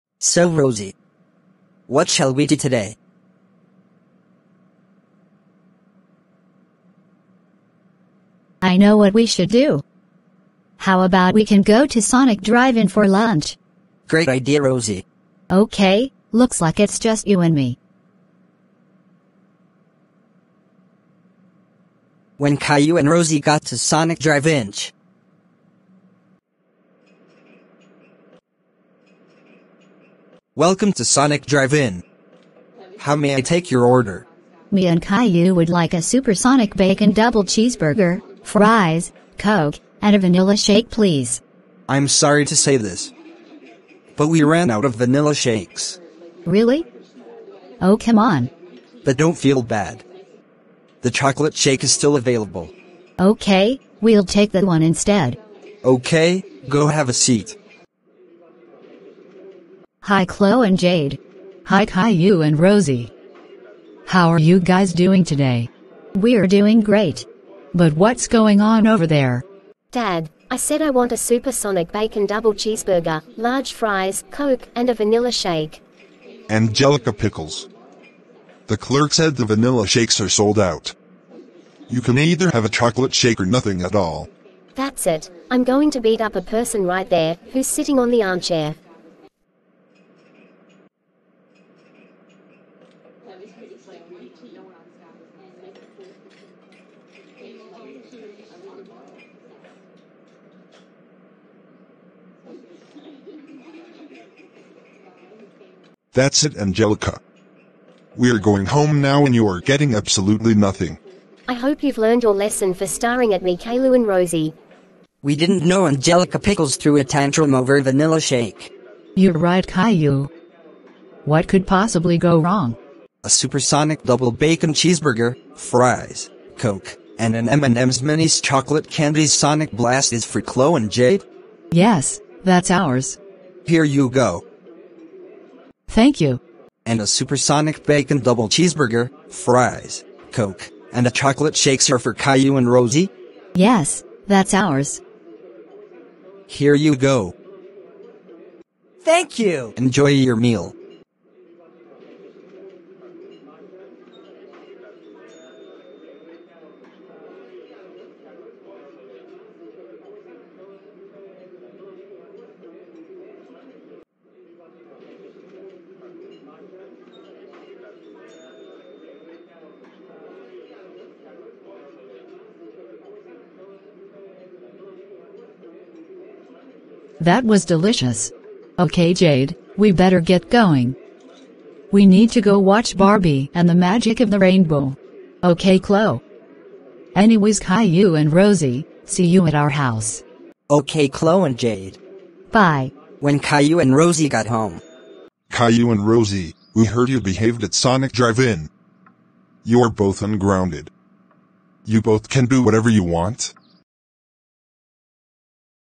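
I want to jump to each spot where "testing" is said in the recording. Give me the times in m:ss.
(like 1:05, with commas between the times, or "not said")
not said.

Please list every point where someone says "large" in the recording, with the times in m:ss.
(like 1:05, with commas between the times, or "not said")
1:13.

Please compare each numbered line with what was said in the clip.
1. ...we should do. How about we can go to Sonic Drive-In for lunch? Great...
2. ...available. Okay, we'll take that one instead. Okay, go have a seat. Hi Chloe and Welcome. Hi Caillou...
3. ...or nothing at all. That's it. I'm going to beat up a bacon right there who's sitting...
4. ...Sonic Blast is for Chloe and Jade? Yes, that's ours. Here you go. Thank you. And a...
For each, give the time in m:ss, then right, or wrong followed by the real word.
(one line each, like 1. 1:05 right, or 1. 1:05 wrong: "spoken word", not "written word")
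1. 0:09 right
2. 0:52 wrong: "Jade", not "Welcome"
3. 1:23 wrong: "person", not "bacon"
4. 2:09 right.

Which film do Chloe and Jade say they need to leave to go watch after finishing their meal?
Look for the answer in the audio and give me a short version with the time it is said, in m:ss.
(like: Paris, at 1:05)
Barbie and the Magic of the Rainbow, at 3:02.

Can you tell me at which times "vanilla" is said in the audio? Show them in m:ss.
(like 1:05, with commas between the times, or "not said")
0:40, 0:44, 1:14, 1:19, 1:57.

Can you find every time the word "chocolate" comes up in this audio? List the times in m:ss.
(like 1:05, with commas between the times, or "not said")
0:51, 1:22, 2:08, 2:21.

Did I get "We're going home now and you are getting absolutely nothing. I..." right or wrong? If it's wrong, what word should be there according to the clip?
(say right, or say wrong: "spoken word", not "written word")
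right.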